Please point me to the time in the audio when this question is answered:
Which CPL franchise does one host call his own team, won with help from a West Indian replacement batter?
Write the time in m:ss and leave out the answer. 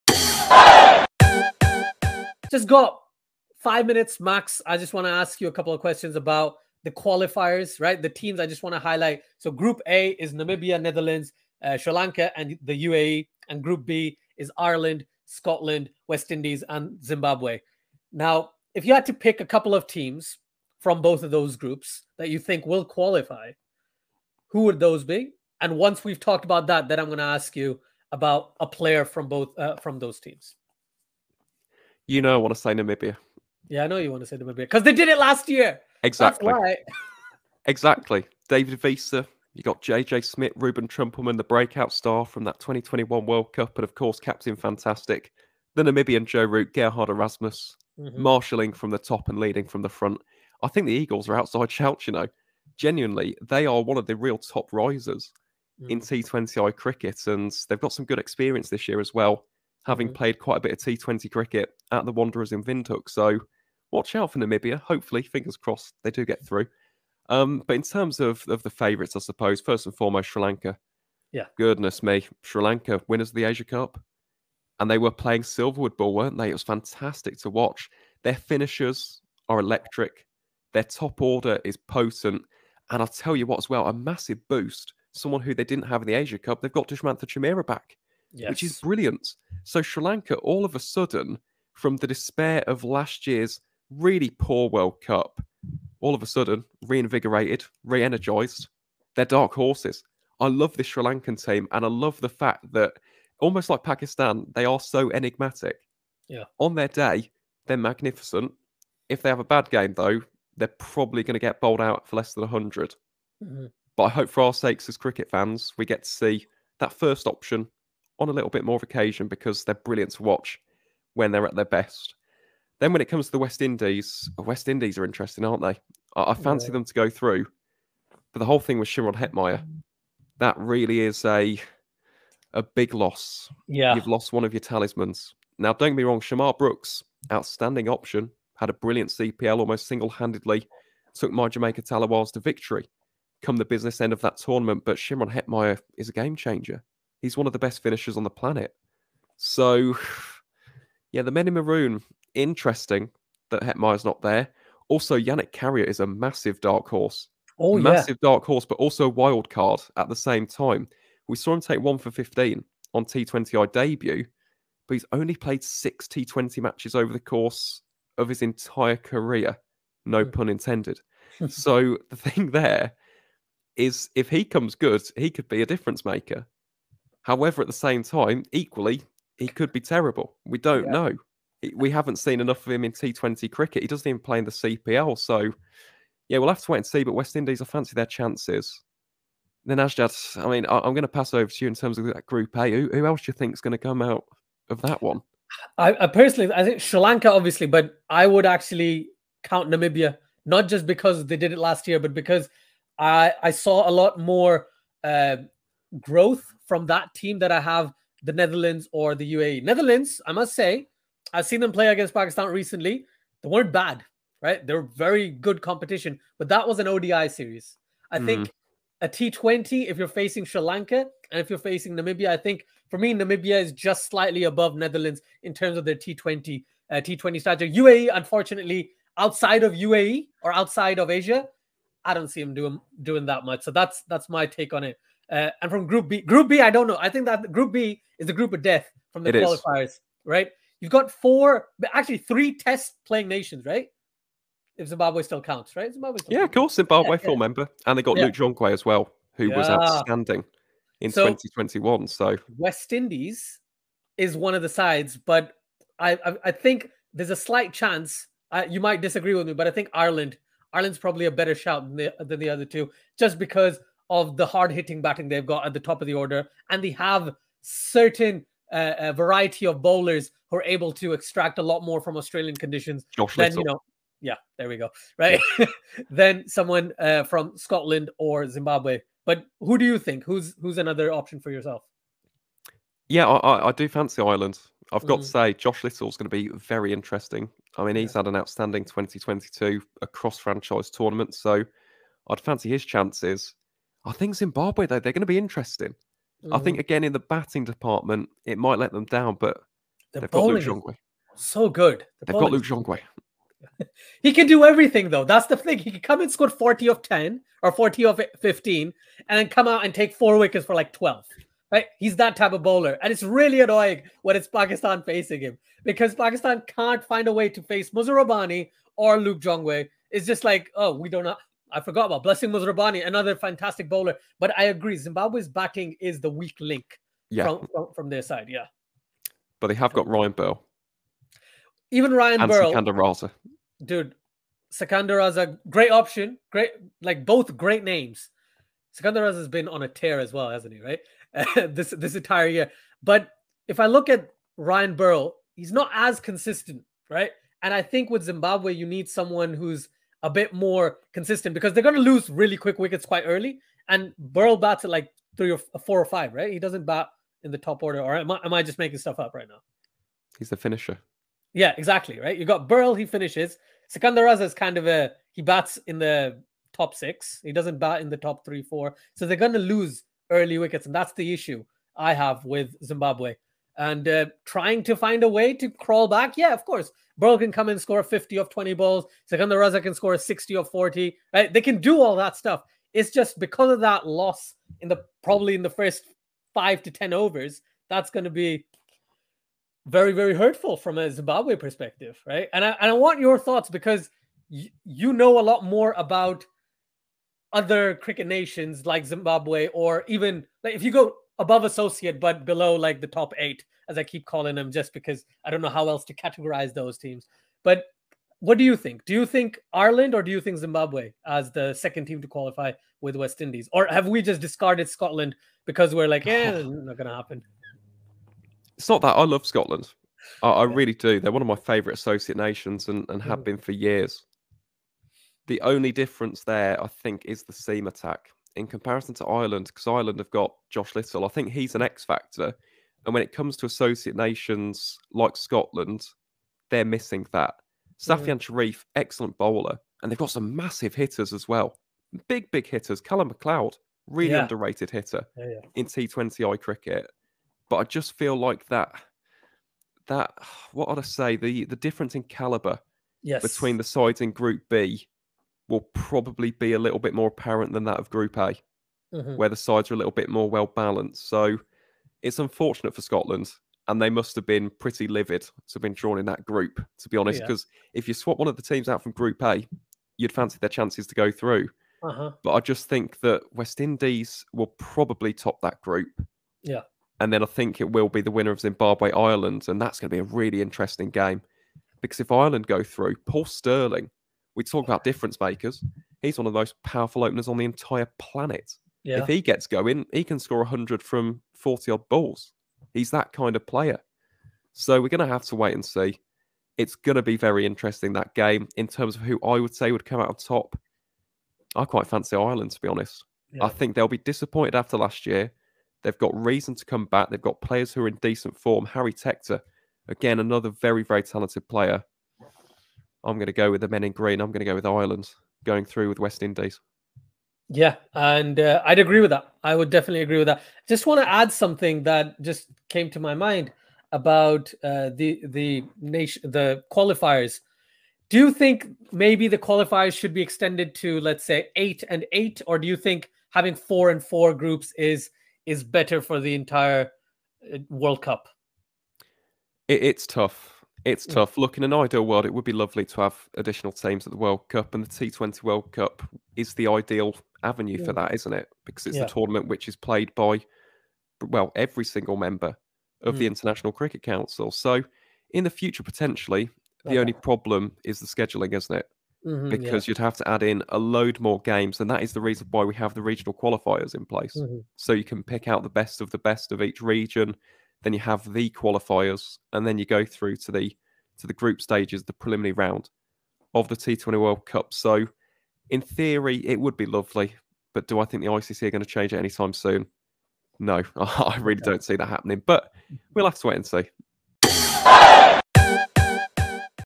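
2:21.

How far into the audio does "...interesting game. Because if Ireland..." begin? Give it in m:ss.
8:00.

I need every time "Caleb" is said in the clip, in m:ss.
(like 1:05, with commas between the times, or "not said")
not said.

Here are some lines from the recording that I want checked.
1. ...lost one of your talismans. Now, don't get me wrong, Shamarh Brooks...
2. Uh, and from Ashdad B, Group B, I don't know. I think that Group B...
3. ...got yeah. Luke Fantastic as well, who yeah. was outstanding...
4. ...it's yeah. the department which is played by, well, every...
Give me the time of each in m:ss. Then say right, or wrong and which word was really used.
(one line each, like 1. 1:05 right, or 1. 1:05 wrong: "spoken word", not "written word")
1. 2:14 right
2. 3:55 wrong: "Group", not "Ashdad"
3. 4:08 wrong: "Jongwe", not "Fantastic"
4. 9:09 wrong: "tournament", not "department".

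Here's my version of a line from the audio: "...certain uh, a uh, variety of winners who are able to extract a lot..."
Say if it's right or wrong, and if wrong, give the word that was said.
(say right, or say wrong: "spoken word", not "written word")
wrong: "bowlers", not "winners".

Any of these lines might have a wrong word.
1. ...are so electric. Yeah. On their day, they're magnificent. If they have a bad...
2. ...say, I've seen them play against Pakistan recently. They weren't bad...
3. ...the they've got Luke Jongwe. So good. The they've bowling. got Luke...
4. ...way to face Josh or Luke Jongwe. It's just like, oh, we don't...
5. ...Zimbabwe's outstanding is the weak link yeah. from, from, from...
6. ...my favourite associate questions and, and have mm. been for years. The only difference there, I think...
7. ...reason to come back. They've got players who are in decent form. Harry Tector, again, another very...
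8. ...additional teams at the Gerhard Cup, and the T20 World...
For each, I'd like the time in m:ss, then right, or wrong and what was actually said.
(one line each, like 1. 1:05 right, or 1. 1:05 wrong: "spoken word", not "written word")
1. 1:44 wrong: "enigmatic", not "electric"
2. 3:30 right
3. 5:00 right
4. 5:17 wrong: "Muzarabani", not "Josh"
5. 5:24 wrong: "batting", not "outstanding"
6. 7:01 wrong: "nations", not "questions"
7. 8:26 right
8. 9:03 wrong: "World", not "Gerhard".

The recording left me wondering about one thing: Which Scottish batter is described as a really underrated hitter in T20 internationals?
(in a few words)
Calum MacLeod.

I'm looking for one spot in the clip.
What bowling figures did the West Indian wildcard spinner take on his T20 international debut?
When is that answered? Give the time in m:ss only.
2:41.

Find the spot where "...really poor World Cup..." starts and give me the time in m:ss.
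1:33.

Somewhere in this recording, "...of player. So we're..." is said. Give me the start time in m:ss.
8:13.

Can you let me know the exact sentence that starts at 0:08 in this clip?
The teams I just want to highlight.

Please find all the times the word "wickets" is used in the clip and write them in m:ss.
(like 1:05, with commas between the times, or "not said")
5:10, 5:52, 6:10.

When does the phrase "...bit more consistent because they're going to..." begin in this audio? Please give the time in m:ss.
5:50.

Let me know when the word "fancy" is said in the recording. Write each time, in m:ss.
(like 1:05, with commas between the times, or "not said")
2:06, 3:07, 4:43, 4:52, 7:50, 8:22.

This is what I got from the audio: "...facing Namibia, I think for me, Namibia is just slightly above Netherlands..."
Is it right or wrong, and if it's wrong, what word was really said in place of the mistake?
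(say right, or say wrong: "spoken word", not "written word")
right.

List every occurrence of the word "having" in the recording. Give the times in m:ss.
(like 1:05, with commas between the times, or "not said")
0:59, 8:53.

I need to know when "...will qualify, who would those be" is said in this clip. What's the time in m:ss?
0:22.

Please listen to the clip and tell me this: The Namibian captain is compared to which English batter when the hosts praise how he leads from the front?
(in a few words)
Joe Root.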